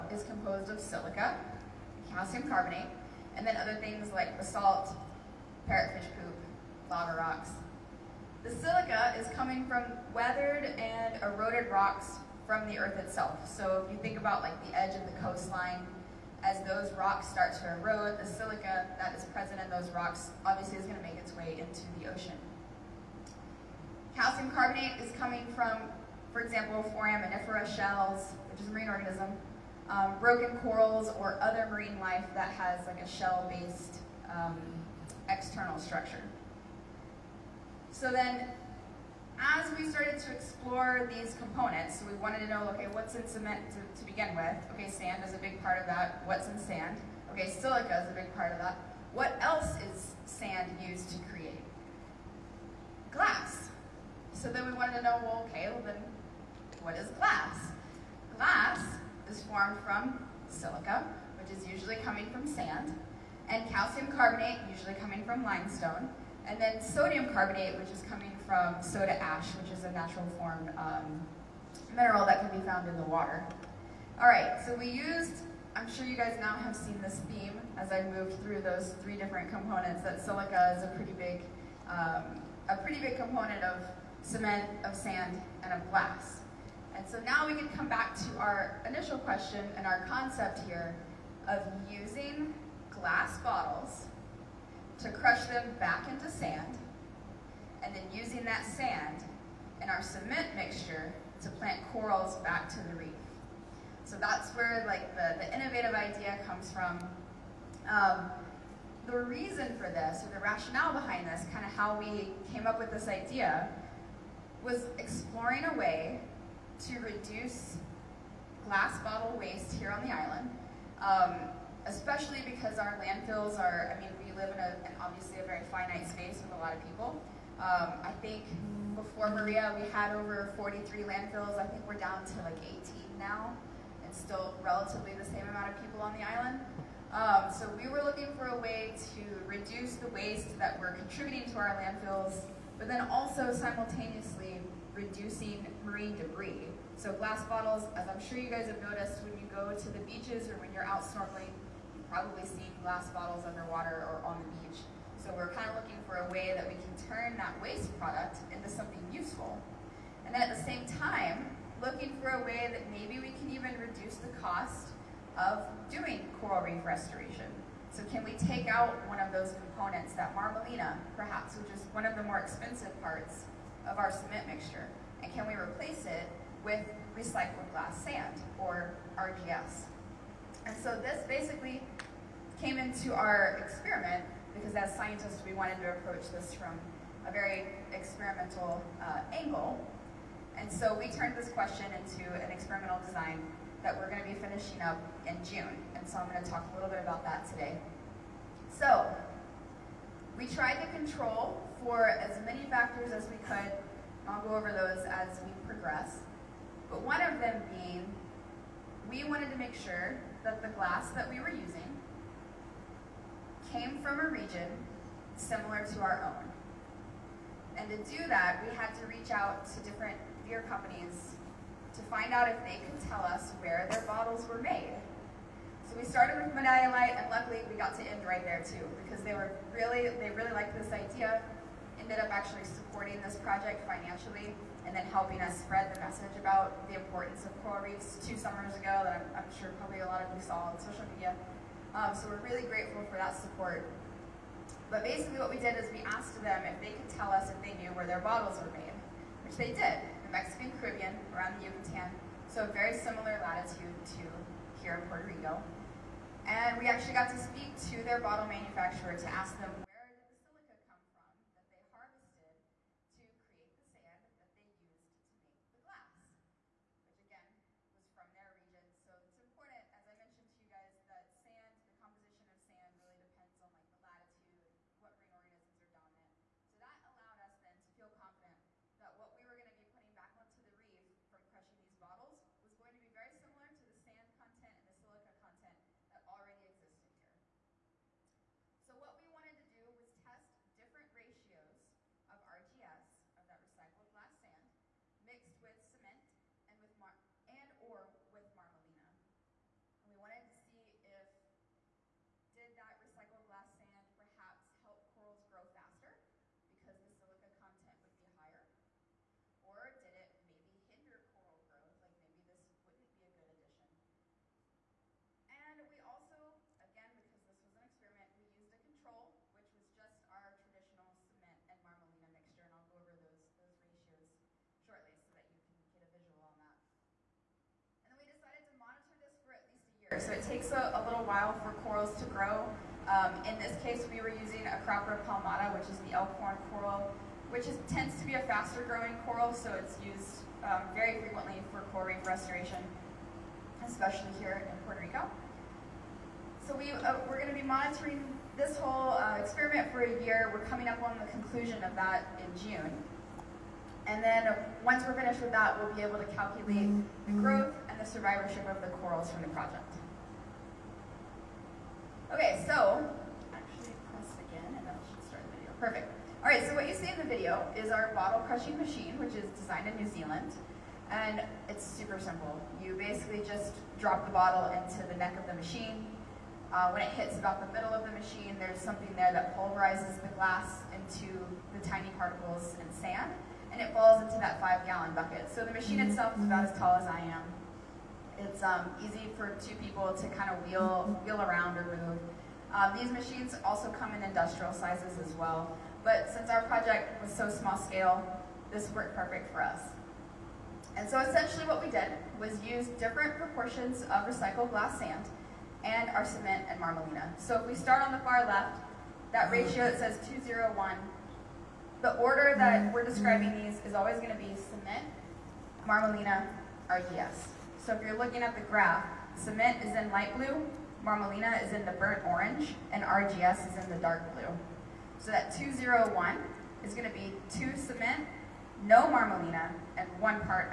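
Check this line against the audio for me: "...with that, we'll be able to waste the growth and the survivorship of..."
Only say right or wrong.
wrong.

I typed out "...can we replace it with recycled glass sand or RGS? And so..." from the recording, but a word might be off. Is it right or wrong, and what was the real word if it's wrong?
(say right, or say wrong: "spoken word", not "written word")
right.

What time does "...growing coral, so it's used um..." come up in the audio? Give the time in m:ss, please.
5:38.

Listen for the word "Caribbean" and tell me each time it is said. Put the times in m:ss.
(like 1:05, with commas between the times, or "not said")
4:10.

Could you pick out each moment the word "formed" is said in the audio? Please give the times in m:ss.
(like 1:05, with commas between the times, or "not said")
0:59, 1:10.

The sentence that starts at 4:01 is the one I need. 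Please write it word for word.
Um, so we're really grateful for that support.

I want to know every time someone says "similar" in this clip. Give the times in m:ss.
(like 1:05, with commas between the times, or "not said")
3:35, 4:12, 4:43.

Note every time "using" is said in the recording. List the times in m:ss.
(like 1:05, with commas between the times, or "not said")
1:31, 1:38, 3:31, 5:34.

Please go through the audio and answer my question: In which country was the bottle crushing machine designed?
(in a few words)
New Zealand.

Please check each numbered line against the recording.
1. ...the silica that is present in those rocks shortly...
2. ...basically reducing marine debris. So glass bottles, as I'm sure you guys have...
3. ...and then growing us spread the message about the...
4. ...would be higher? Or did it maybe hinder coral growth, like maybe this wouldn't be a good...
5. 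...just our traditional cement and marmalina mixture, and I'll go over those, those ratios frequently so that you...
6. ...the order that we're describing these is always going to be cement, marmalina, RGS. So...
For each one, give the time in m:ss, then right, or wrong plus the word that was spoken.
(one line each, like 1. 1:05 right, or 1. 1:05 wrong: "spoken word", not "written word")
1. 0:18 wrong: "obviously", not "shortly"
2. 2:23 wrong: "simultaneously", not "basically"
3. 3:54 wrong: "helping", not "growing"
4. 5:08 right
5. 5:19 wrong: "shortly", not "frequently"
6. 6:52 right.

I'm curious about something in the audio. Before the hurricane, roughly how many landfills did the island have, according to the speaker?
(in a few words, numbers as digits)
43.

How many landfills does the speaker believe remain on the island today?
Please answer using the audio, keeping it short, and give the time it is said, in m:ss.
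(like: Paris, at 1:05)
18, at 2:12.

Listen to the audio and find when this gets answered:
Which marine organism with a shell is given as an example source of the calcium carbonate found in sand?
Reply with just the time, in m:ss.
0:26.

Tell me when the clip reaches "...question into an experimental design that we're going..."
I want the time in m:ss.
3:11.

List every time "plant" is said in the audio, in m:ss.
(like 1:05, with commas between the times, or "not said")
1:41.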